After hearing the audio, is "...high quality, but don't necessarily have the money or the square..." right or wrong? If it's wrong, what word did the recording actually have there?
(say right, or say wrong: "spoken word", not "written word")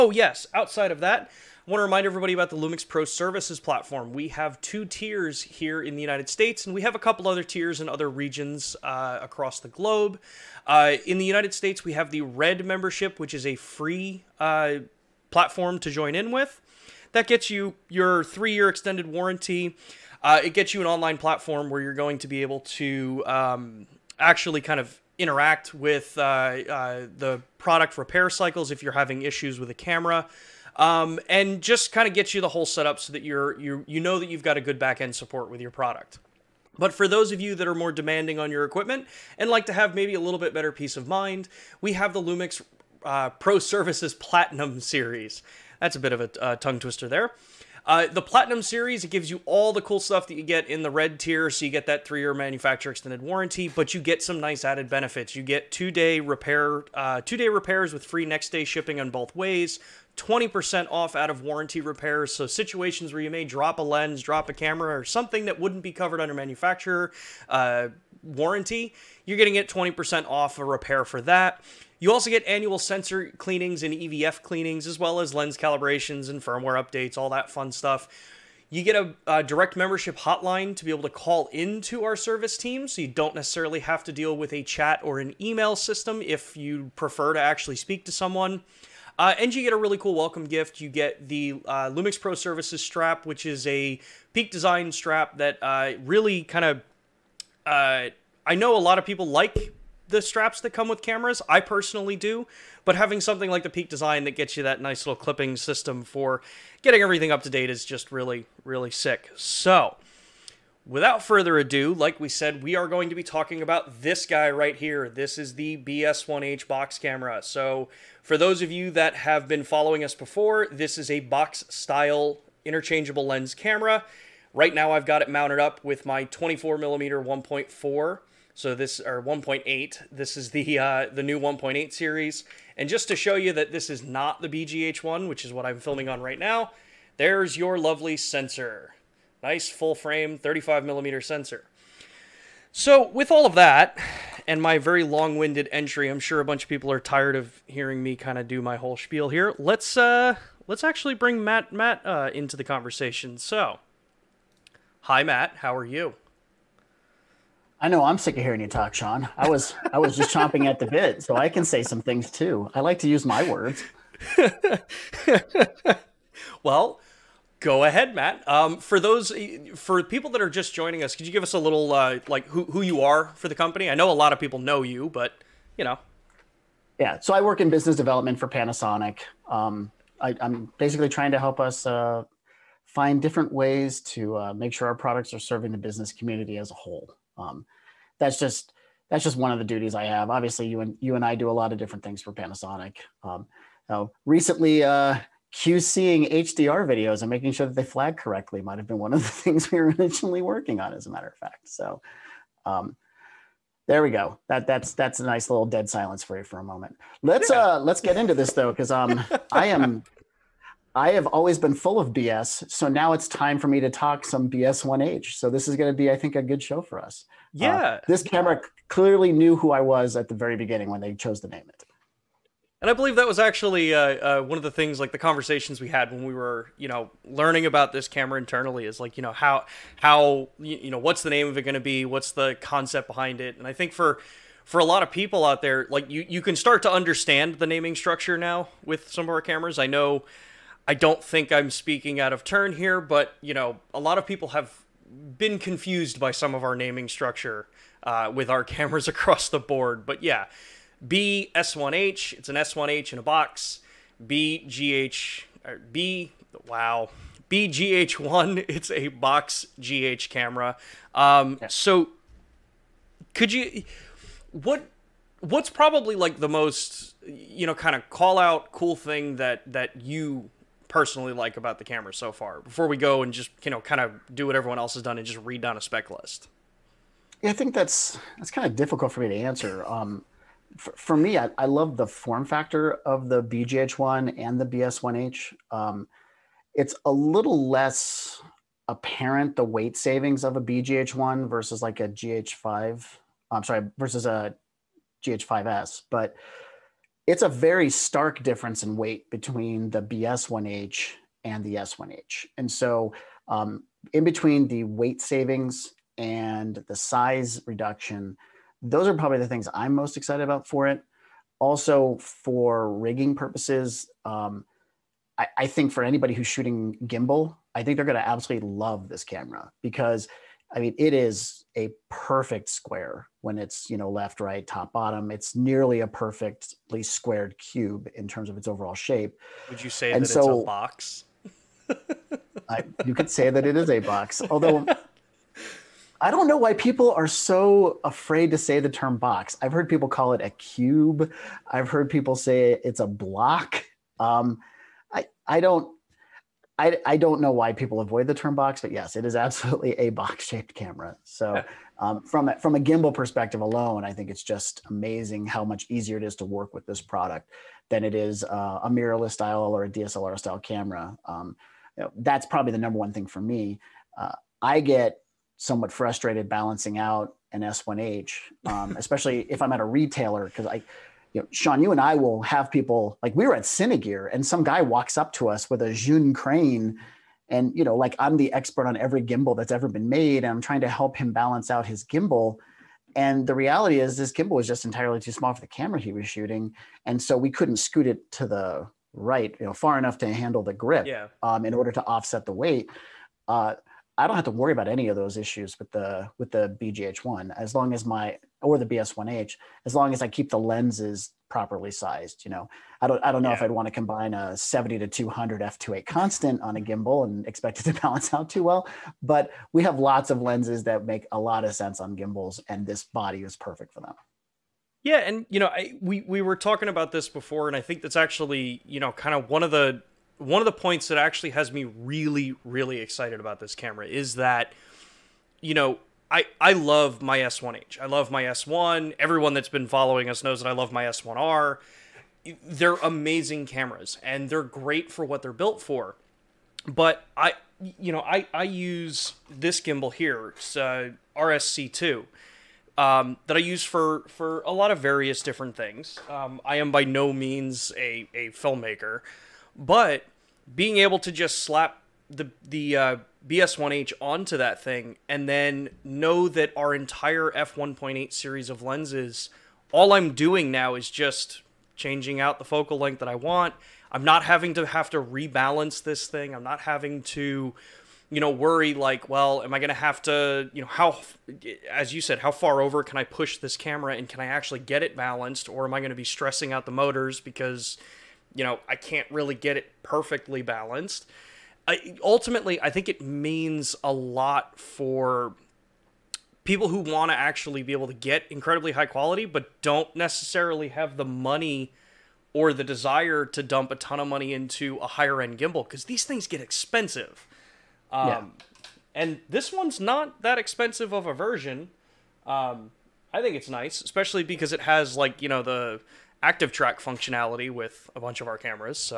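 wrong: "desire", not "square".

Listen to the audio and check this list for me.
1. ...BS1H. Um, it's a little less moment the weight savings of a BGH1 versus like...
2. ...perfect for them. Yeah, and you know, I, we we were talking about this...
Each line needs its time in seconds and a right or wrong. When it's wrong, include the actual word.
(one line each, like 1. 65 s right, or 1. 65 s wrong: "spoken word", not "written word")
1. 284 s wrong: "apparent", not "moment"
2. 413 s right.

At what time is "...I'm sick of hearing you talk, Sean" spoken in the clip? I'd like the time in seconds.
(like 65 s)
158 s.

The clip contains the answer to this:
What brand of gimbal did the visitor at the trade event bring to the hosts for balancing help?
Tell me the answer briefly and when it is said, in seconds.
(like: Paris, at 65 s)
Zhiyun, at 375 s.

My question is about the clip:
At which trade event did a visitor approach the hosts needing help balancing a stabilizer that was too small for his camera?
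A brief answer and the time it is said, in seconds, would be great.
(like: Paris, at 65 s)
Cinegear, at 373 s.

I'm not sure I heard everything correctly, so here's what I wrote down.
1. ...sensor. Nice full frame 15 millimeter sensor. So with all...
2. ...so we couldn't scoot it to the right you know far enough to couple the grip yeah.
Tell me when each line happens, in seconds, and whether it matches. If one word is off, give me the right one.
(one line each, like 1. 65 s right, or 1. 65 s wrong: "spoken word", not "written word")
1. 138 s wrong: "35", not "15"
2. 387 s wrong: "handle", not "couple".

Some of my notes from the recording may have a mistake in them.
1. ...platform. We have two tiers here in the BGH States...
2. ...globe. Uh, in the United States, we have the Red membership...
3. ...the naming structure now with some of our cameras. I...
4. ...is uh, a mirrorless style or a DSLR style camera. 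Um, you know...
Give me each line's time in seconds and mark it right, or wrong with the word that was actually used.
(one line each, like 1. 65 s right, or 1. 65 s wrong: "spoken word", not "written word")
1. 3 s wrong: "United", not "BGH"
2. 9 s right
3. 237 s right
4. 358 s right.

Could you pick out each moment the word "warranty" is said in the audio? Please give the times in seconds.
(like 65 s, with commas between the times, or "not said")
19 s, 53 s, 61 s, 68 s.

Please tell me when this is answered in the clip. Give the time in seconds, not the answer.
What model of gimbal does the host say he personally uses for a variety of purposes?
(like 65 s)
441 s.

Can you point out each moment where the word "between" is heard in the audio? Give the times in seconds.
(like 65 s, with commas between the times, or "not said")
299 s, 304 s.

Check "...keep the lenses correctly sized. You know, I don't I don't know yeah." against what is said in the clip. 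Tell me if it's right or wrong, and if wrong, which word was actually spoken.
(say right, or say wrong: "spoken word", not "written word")
wrong: "properly", not "correctly".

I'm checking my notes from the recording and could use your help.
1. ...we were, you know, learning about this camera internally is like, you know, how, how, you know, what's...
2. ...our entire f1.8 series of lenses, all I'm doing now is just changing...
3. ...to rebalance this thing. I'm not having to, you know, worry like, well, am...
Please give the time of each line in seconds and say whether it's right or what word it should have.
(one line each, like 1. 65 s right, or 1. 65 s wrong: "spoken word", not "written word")
1. 226 s right
2. 456 s right
3. 465 s right.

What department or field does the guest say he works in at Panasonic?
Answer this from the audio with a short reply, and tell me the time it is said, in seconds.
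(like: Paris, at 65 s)
Business development, at 177 s.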